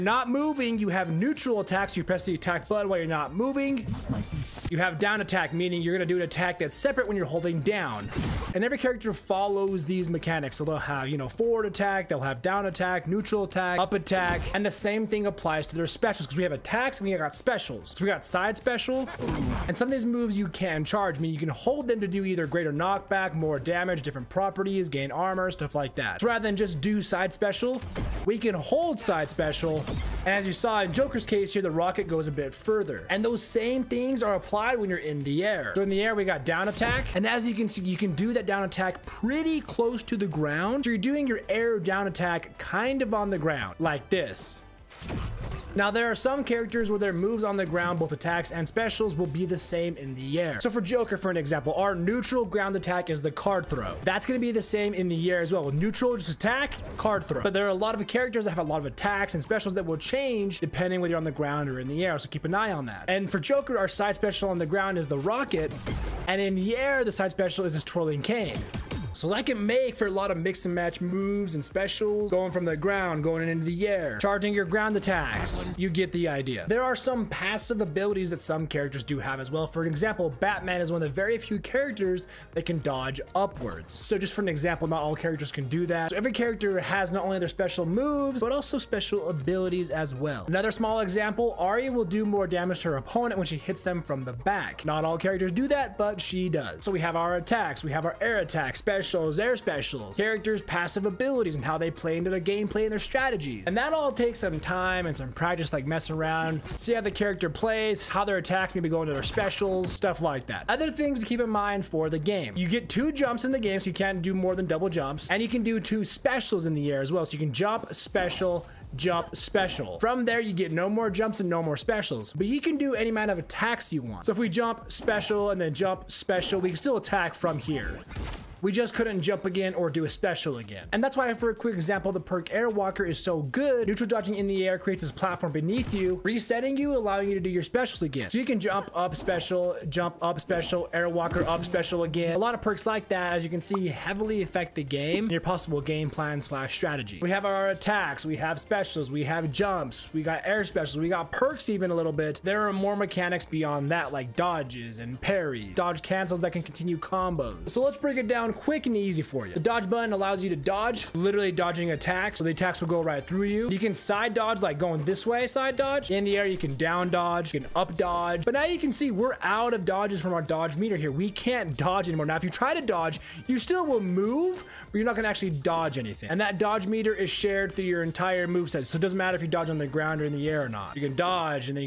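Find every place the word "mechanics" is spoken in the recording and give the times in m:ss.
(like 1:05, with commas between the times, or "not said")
0:10, 2:32.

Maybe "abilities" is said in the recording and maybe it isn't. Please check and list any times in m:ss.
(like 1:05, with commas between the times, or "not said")
1:17, 1:29, 1:41.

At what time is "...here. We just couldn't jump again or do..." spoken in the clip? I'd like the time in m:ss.
2:07.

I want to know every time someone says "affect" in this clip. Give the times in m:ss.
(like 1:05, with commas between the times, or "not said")
2:24.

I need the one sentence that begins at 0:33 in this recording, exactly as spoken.
And those same things are applied applied when you're in the air.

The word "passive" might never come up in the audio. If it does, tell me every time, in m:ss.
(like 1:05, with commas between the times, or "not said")
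1:17, 1:40.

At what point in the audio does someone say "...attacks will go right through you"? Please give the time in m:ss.
2:42.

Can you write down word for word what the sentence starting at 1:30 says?
Another small example, Arya will do more damage to her opponent when she hits them from the back.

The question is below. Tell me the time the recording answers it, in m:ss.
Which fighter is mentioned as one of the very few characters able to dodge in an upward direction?
1:20.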